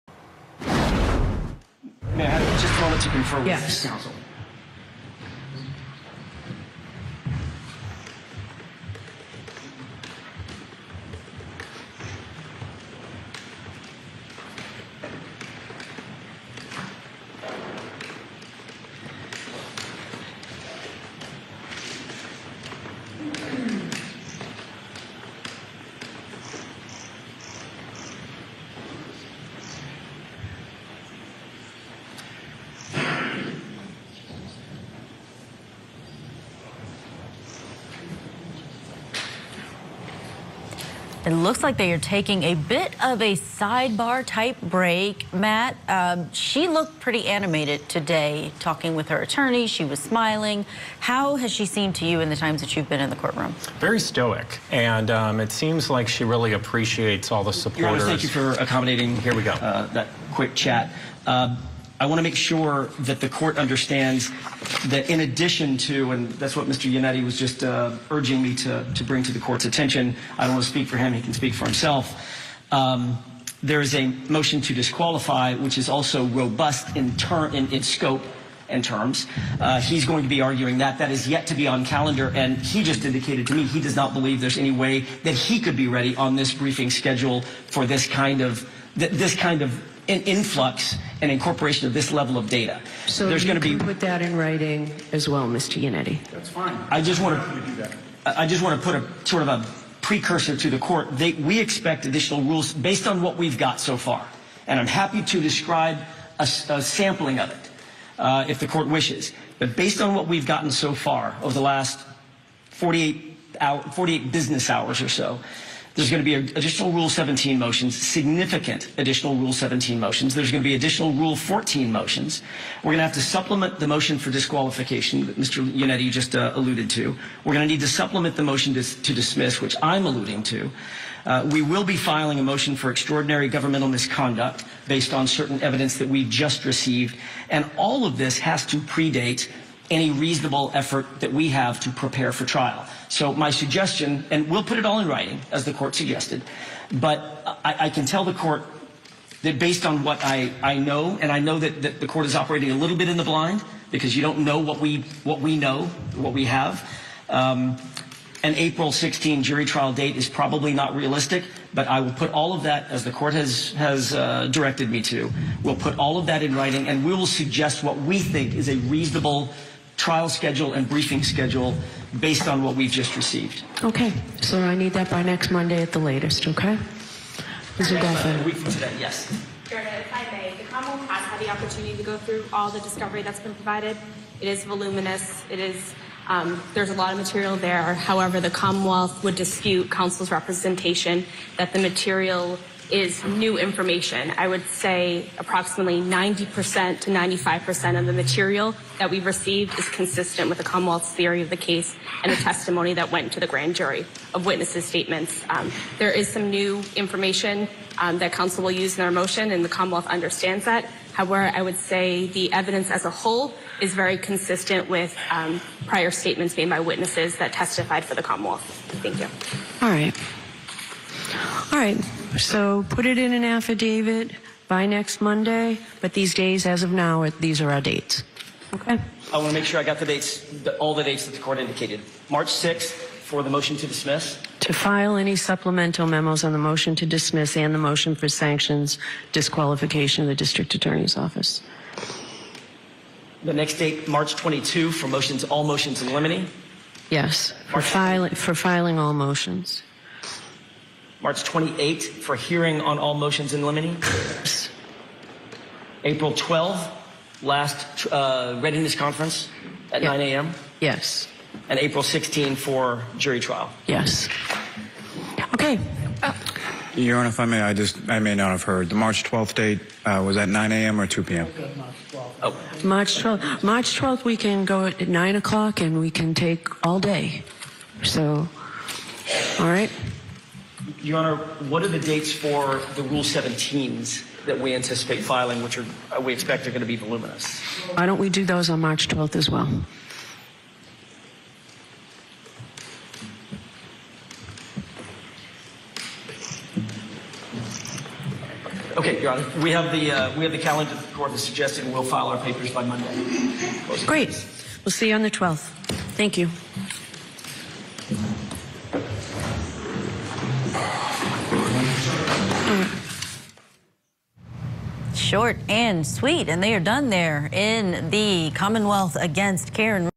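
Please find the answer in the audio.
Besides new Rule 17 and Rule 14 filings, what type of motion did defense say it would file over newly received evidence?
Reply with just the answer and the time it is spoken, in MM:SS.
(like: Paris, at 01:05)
Extraordinary governmental misconduct, at 02:12.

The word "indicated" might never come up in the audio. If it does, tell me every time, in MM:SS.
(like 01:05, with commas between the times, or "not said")
01:23, 03:51.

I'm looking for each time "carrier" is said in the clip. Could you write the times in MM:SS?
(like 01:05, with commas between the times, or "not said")
not said.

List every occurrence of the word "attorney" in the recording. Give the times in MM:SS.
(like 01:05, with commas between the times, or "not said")
00:49, 04:00.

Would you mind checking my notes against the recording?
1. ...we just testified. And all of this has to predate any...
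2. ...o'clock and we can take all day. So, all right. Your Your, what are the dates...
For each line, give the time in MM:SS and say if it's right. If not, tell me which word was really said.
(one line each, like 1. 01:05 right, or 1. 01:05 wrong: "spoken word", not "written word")
1. 02:16 wrong: "received", not "testified"
2. 04:35 wrong: "Honor", not "Your".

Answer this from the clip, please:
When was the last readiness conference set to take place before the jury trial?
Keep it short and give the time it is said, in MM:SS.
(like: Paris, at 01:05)
April 12, at 04:16.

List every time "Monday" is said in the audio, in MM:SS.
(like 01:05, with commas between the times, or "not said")
02:55, 03:45, 05:02.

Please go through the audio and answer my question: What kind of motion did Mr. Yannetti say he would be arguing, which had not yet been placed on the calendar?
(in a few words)
Motion to disqualify.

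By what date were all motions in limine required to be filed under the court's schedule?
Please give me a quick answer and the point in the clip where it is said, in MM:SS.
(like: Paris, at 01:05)
March 22, at 04:04.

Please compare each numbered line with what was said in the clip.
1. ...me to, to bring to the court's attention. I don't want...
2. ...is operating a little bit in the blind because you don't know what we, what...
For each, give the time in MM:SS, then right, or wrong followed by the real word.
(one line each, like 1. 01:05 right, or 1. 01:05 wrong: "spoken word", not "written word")
1. 01:08 right
2. 02:32 right.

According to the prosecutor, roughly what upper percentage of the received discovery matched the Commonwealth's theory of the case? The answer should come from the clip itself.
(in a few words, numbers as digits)
95%.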